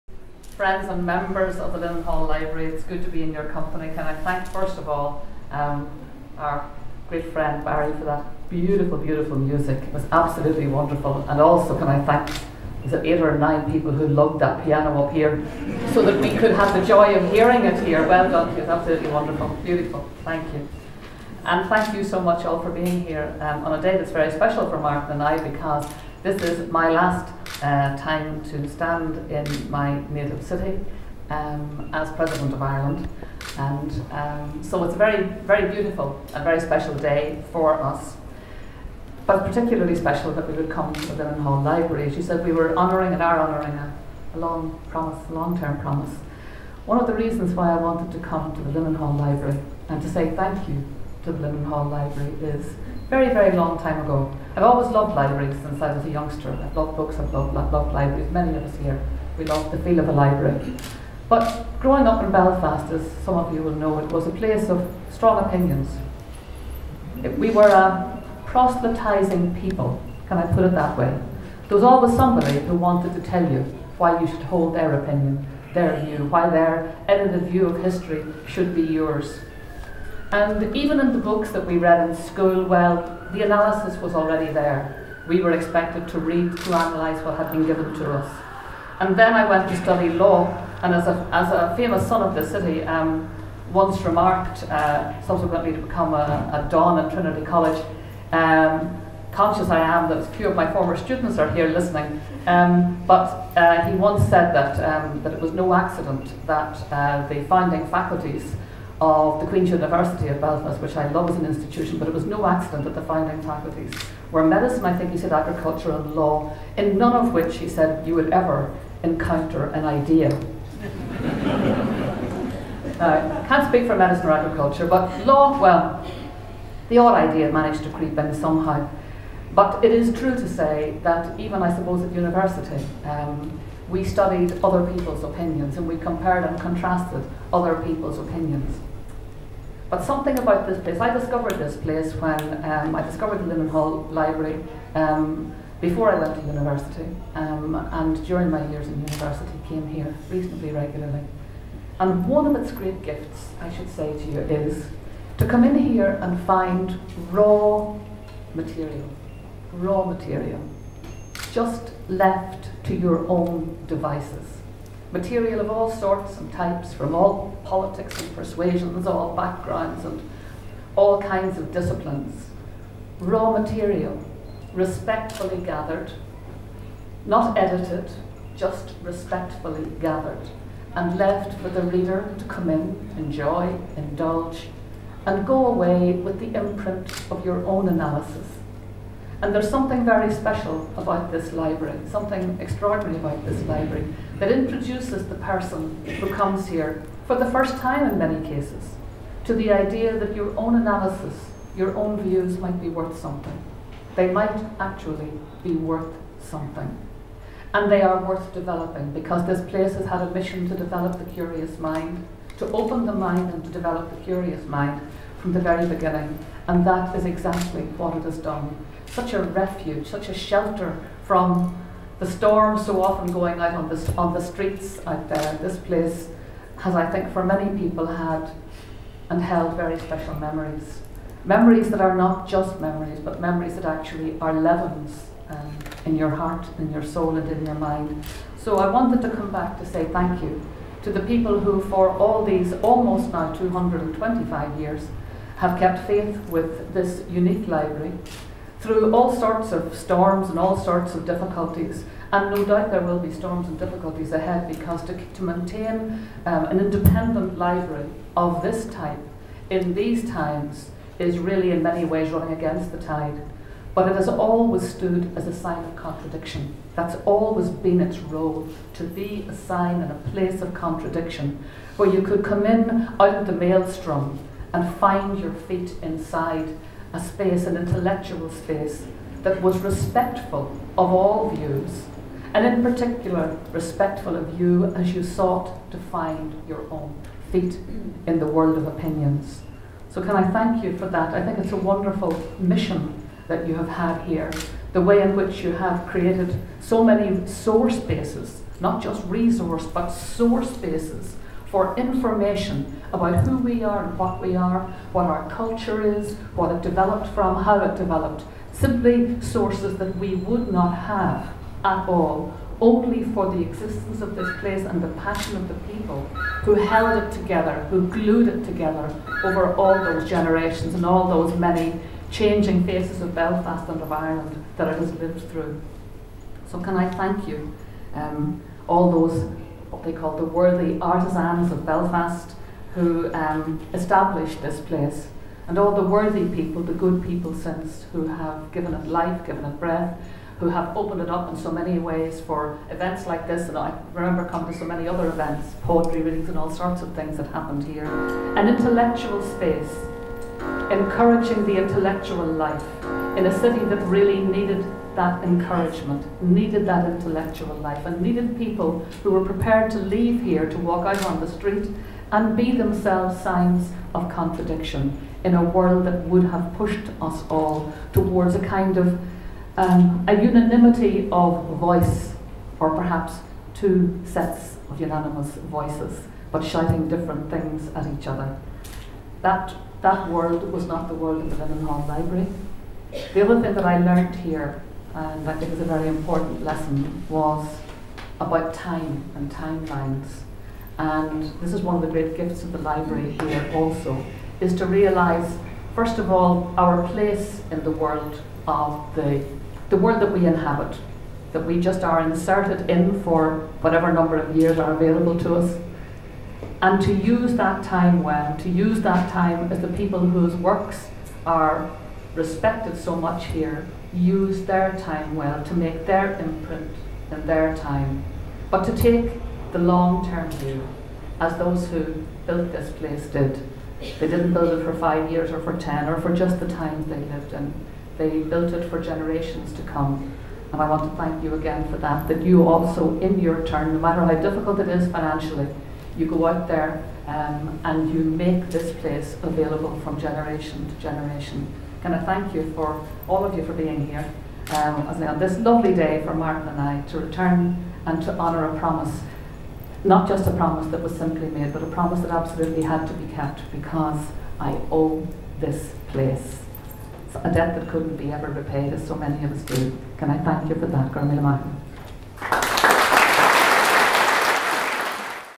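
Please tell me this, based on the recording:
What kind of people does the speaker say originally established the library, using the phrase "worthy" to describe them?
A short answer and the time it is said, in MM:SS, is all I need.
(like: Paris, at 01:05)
artisans of Belfast, at 05:31.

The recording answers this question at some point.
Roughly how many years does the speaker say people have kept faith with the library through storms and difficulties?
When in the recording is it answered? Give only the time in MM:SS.
04:03.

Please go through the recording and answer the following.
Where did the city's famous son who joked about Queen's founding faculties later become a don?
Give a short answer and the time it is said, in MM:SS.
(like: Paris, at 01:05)
Trinity College, at 01:37.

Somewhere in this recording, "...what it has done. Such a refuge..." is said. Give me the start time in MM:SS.
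03:37.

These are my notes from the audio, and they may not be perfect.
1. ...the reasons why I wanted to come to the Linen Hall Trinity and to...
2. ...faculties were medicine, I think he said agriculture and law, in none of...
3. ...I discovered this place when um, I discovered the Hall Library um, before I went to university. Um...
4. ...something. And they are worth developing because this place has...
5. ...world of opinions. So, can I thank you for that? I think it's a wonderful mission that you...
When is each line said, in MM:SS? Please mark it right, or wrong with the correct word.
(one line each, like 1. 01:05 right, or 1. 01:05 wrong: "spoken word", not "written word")
1. 00:47 wrong: "Library", not "Trinity"
2. 01:53 right
3. 02:21 right
4. 03:26 right
5. 04:48 right.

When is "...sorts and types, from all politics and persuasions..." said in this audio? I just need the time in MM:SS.
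02:45.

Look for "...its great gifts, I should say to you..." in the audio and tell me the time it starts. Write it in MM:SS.
02:32.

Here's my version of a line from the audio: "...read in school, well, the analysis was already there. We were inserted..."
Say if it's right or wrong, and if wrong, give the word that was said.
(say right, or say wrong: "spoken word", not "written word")
wrong: "expected", not "inserted".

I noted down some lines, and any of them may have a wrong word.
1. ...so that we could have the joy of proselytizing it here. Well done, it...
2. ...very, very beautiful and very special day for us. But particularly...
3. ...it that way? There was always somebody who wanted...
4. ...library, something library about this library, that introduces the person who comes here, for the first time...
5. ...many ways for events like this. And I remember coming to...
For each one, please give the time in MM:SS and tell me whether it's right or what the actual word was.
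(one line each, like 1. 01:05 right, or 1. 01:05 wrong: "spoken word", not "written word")
1. 00:15 wrong: "hearing", not "proselytizing"
2. 00:34 right
3. 01:10 right
4. 03:11 wrong: "extraordinary", not "library"
5. 05:41 right.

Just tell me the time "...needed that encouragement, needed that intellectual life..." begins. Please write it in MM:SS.
05:54.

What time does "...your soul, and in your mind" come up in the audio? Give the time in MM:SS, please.
03:56.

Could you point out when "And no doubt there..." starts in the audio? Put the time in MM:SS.
04:12.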